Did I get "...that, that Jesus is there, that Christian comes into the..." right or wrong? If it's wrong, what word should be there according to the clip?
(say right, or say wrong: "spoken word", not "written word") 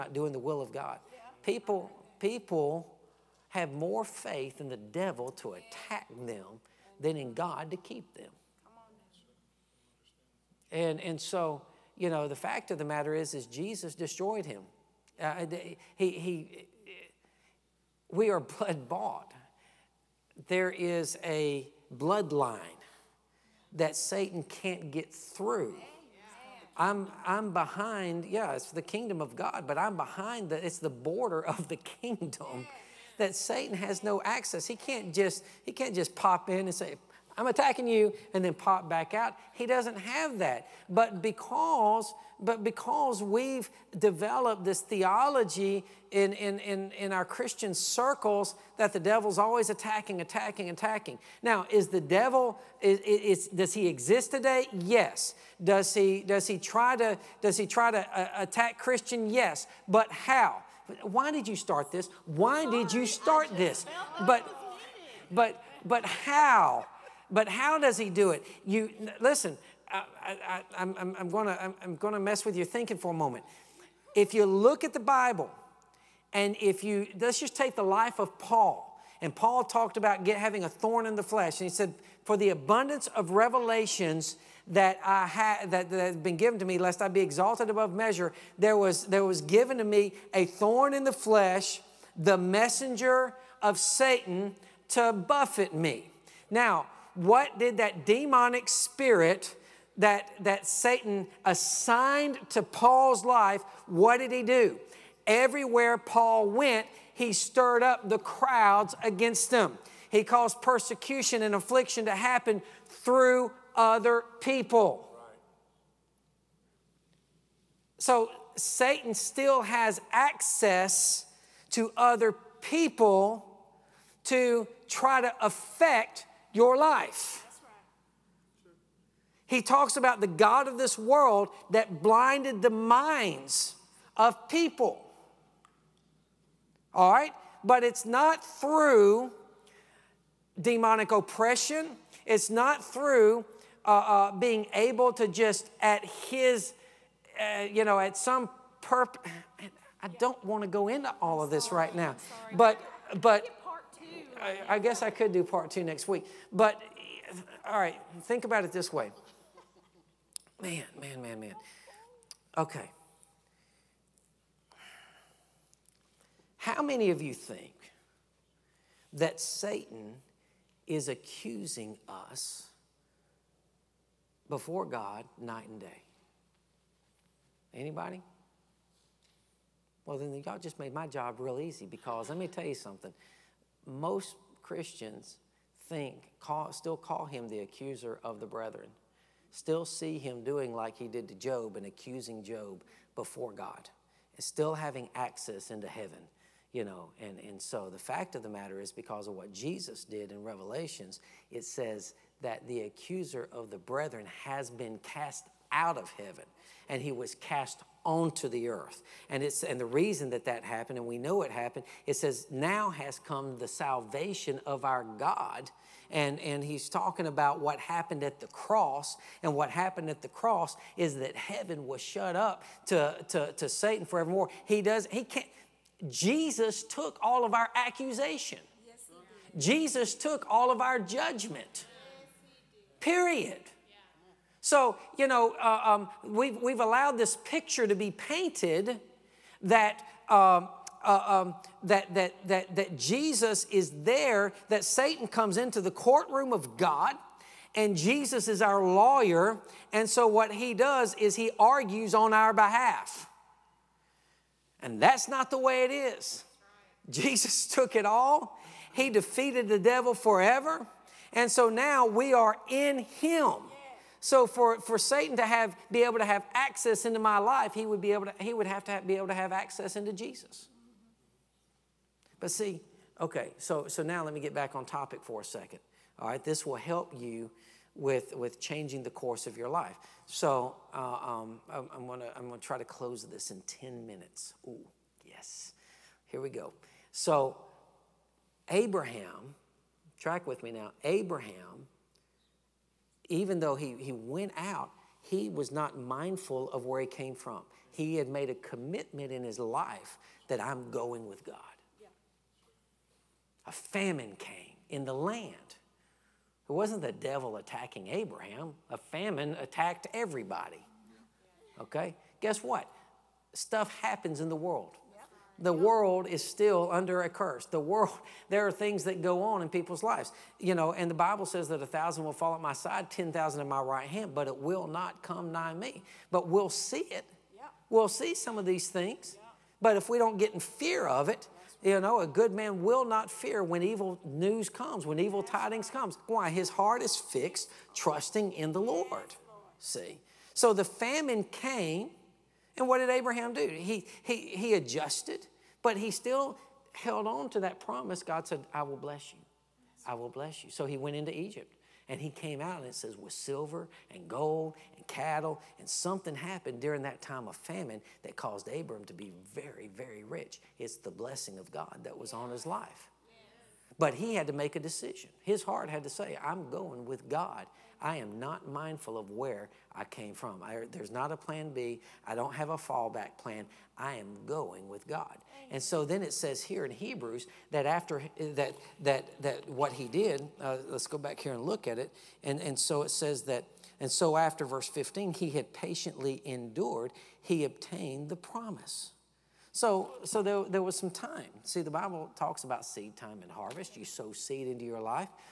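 wrong: "Satan", not "Christian".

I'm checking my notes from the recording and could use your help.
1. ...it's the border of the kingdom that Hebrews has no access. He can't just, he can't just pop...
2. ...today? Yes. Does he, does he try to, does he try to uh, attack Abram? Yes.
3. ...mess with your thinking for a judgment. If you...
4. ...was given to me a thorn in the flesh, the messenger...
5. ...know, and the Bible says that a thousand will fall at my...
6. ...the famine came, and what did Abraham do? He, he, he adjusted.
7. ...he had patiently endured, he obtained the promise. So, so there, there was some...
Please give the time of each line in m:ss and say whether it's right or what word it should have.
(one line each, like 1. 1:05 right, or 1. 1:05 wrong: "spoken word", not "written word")
1. 0:30 wrong: "Satan", not "Hebrews"
2. 0:54 wrong: "Christian", not "Abram"
3. 1:12 wrong: "moment", not "judgment"
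4. 1:29 right
5. 5:20 right
6. 5:40 right
7. 6:25 right.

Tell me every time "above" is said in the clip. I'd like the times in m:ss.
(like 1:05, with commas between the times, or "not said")
1:27.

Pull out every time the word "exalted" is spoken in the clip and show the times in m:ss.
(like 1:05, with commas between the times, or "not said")
1:27.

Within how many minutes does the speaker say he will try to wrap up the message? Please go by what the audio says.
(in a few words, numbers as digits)
10.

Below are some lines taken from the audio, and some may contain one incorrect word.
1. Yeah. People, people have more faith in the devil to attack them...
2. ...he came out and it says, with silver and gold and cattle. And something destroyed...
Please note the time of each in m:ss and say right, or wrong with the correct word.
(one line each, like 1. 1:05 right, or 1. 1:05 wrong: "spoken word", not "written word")
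1. 0:01 right
2. 5:52 wrong: "happened", not "destroyed".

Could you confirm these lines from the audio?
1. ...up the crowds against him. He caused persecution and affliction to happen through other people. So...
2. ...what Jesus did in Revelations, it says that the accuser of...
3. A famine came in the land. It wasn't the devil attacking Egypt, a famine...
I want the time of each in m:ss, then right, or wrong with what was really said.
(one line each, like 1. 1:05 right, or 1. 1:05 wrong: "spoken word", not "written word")
1. 1:47 right
2. 3:19 right
3. 5:03 wrong: "Abraham", not "Egypt".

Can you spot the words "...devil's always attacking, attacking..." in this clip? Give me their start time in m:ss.
0:48.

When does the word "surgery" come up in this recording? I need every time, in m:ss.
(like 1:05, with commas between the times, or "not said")
not said.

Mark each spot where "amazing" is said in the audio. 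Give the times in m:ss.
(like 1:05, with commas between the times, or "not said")
not said.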